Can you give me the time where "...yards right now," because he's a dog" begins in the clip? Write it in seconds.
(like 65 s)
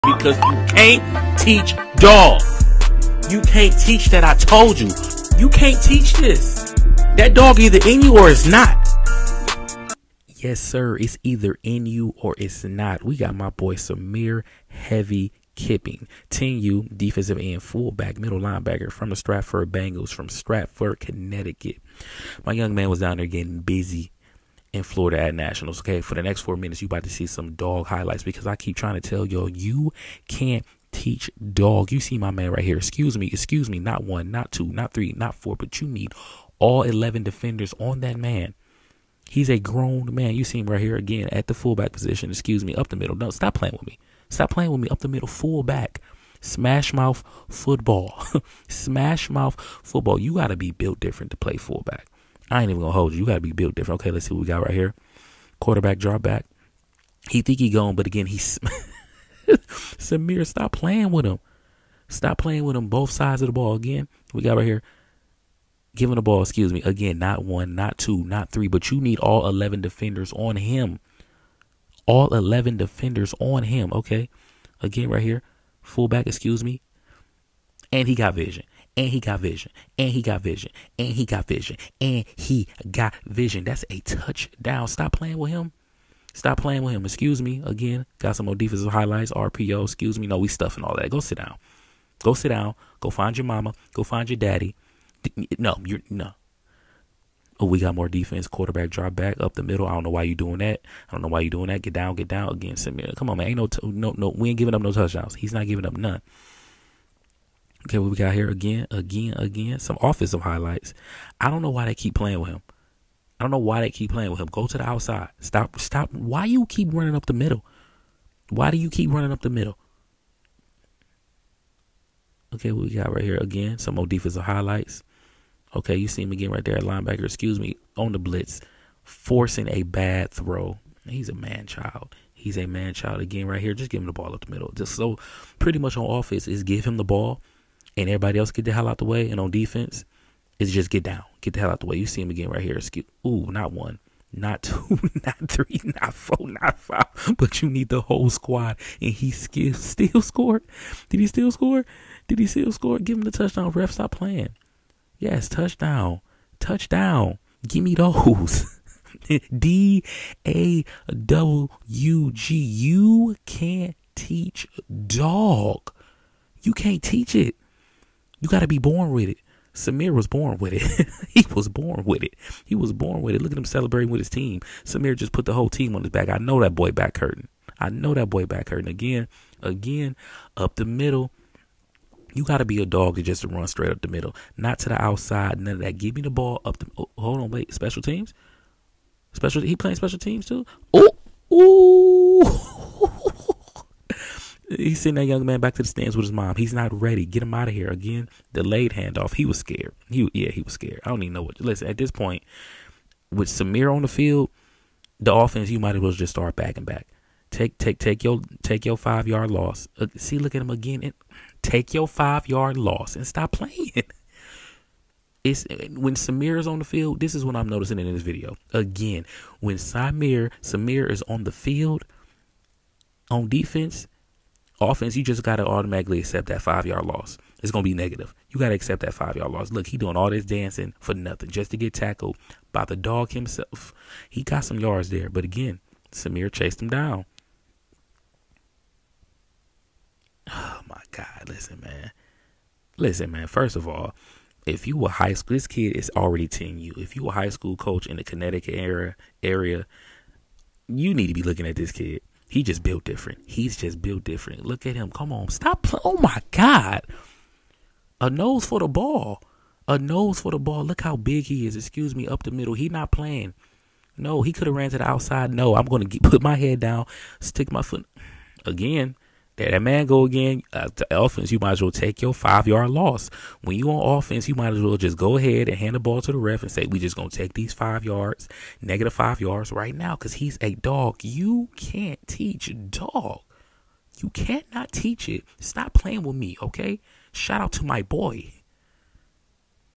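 279 s.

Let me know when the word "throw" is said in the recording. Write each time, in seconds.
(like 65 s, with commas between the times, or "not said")
130 s.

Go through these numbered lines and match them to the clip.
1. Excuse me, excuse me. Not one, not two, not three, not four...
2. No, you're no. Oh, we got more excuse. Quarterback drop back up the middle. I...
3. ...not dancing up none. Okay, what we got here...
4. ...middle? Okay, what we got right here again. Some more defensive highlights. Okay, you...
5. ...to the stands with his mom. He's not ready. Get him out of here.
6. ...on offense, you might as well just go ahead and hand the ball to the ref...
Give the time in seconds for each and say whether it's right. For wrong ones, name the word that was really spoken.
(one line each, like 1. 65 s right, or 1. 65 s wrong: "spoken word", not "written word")
1. 32 s right
2. 95 s wrong: "defense", not "excuse"
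3. 105 s wrong: "giving", not "dancing"
4. 119 s right
5. 195 s right
6. 273 s right.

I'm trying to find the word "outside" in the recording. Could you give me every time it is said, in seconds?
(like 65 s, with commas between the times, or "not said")
114 s, 185 s, 265 s.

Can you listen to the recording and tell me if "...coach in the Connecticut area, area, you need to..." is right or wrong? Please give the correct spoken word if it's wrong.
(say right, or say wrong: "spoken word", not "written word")
right.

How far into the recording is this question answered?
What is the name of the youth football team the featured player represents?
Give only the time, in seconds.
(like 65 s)
19 s.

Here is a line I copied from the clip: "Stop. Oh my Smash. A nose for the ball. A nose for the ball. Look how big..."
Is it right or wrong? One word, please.
wrong.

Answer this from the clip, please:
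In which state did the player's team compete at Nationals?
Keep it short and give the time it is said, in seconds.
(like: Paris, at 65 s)
Florida, at 24 s.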